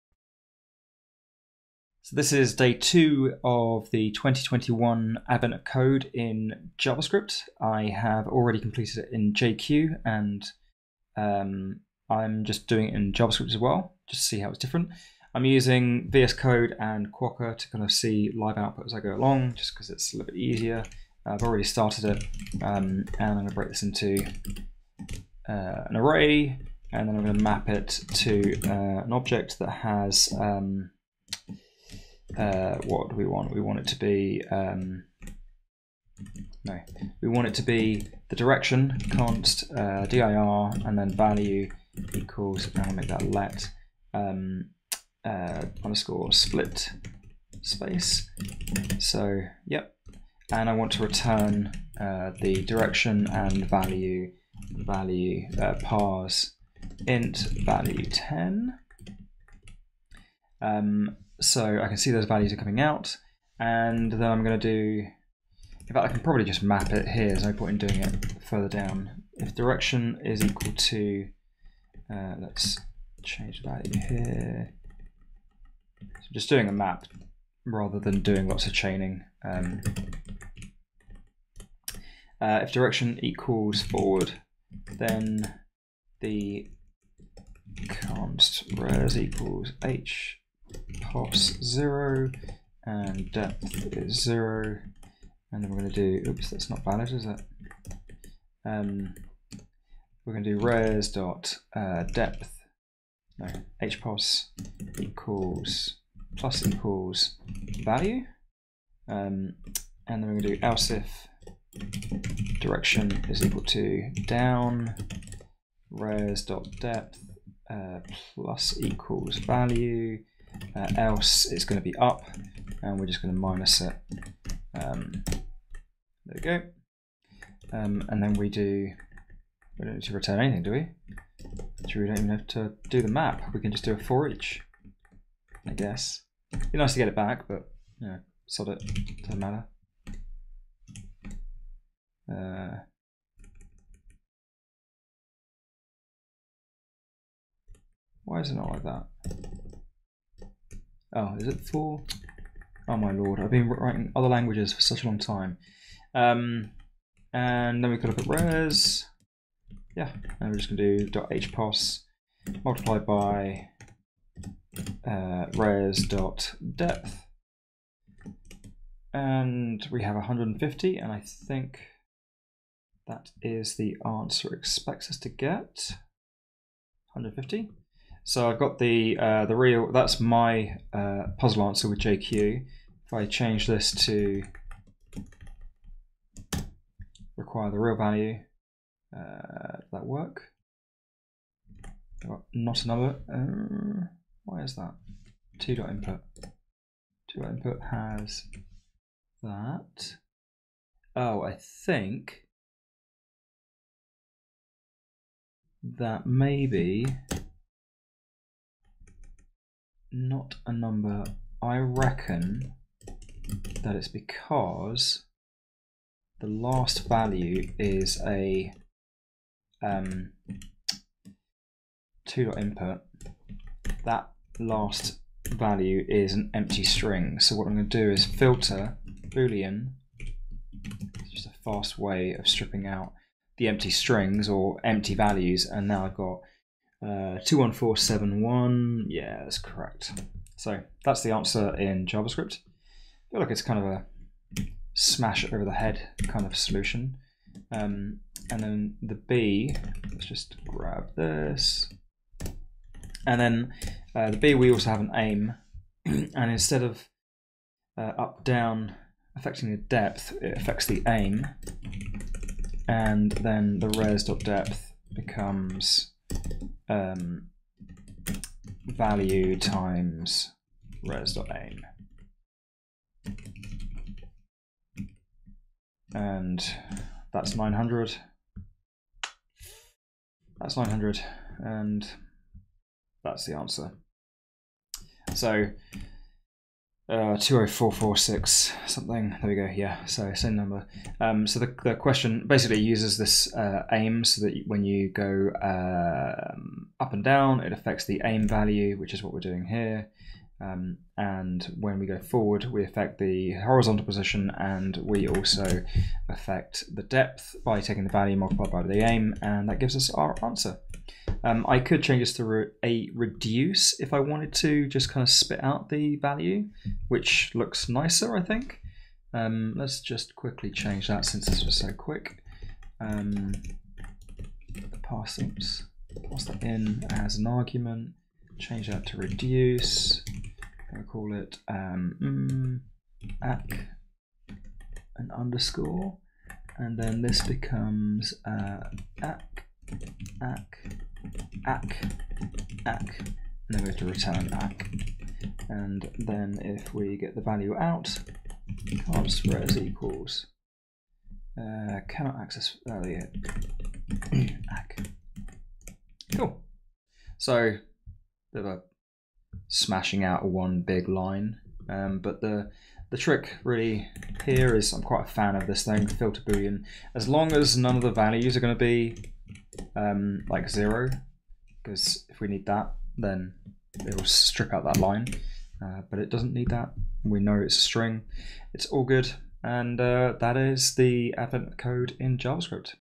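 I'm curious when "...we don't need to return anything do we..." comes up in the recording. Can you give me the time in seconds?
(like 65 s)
129 s.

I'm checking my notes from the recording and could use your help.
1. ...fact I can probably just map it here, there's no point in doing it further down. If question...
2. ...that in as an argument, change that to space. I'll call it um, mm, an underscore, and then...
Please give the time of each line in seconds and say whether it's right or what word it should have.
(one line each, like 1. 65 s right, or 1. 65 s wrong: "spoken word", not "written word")
1. 65 s wrong: "direction", not "question"
2. 326 s wrong: "reduce", not "space".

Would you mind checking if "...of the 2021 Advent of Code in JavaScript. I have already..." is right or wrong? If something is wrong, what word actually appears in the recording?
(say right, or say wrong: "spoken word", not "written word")
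right.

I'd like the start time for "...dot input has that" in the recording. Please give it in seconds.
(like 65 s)
197 s.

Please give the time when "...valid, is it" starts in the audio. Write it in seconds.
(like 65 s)
96 s.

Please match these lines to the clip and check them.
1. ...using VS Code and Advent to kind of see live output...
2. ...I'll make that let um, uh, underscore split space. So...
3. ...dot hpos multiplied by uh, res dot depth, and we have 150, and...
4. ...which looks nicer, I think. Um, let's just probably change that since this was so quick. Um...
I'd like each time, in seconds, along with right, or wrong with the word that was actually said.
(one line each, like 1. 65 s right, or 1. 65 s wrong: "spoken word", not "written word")
1. 15 s wrong: "Quokka", not "Advent"
2. 42 s right
3. 161 s right
4. 317 s wrong: "quickly", not "probably".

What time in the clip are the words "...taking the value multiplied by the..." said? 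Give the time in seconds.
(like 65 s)
307 s.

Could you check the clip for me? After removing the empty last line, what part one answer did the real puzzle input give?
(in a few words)
21471.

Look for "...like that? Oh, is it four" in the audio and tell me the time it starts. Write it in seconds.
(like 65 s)
148 s.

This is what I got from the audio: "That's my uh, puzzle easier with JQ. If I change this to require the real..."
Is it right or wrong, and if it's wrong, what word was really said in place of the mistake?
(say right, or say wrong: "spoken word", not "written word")
wrong: "answer", not "easier".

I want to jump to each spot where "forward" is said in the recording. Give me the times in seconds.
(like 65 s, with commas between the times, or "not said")
83 s, 302 s.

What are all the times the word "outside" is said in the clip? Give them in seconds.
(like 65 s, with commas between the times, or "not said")
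not said.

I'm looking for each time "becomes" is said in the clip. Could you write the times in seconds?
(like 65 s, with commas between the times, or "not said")
265 s, 337 s.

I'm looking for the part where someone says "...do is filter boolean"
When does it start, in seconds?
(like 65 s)
228 s.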